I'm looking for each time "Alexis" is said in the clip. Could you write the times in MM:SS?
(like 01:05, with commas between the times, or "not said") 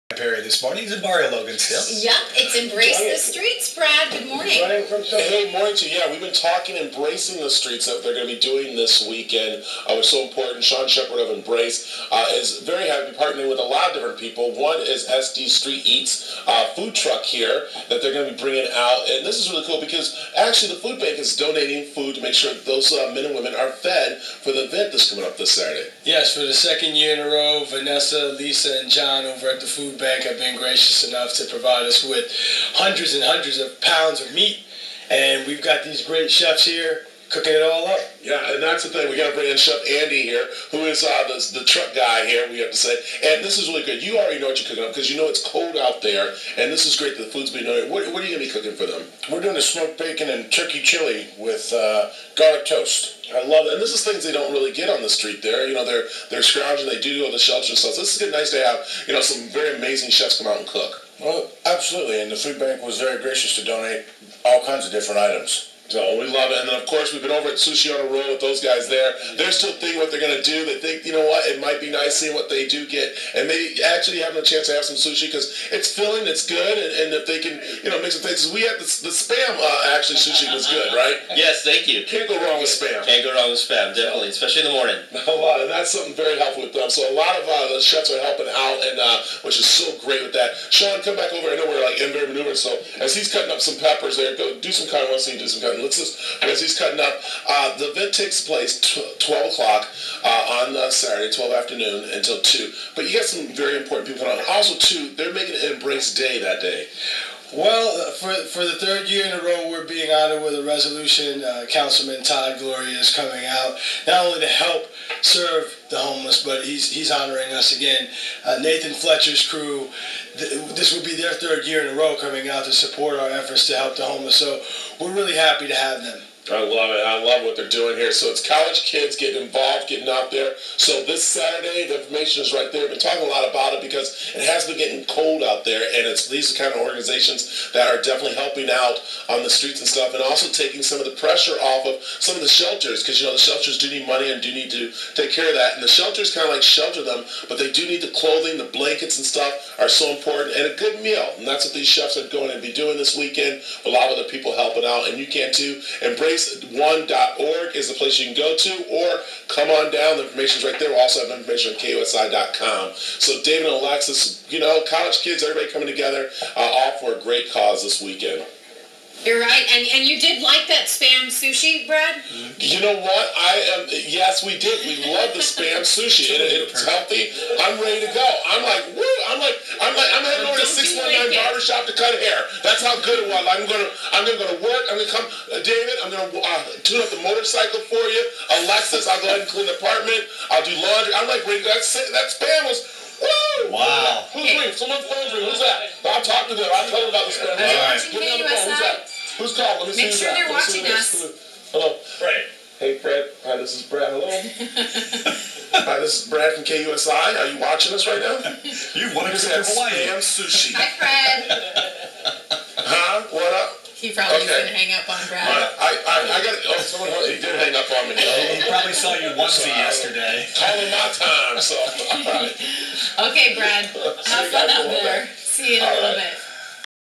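02:43, 03:08.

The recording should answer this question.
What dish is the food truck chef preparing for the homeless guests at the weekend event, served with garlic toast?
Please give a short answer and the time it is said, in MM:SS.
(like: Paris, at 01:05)
Smoked bacon and turkey chili, at 00:49.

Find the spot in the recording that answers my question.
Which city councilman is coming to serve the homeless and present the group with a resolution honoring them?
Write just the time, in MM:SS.
01:52.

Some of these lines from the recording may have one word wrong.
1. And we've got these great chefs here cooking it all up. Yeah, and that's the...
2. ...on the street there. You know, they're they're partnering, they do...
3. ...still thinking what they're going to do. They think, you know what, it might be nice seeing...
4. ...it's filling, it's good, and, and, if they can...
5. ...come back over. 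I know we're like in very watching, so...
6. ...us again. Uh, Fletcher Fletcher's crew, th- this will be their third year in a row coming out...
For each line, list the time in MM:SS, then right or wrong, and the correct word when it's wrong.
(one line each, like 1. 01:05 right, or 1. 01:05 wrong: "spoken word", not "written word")
1. 00:35 right
2. 00:54 wrong: "scrounging", not "partnering"
3. 01:09 right
4. 01:15 right
5. 01:31 wrong: "maneuvering", not "watching"
6. 01:57 wrong: "Nathan", not "Fletcher".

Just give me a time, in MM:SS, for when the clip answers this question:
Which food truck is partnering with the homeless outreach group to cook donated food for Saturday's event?
00:15.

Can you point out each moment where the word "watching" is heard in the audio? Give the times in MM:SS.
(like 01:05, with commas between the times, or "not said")
03:20, 03:27.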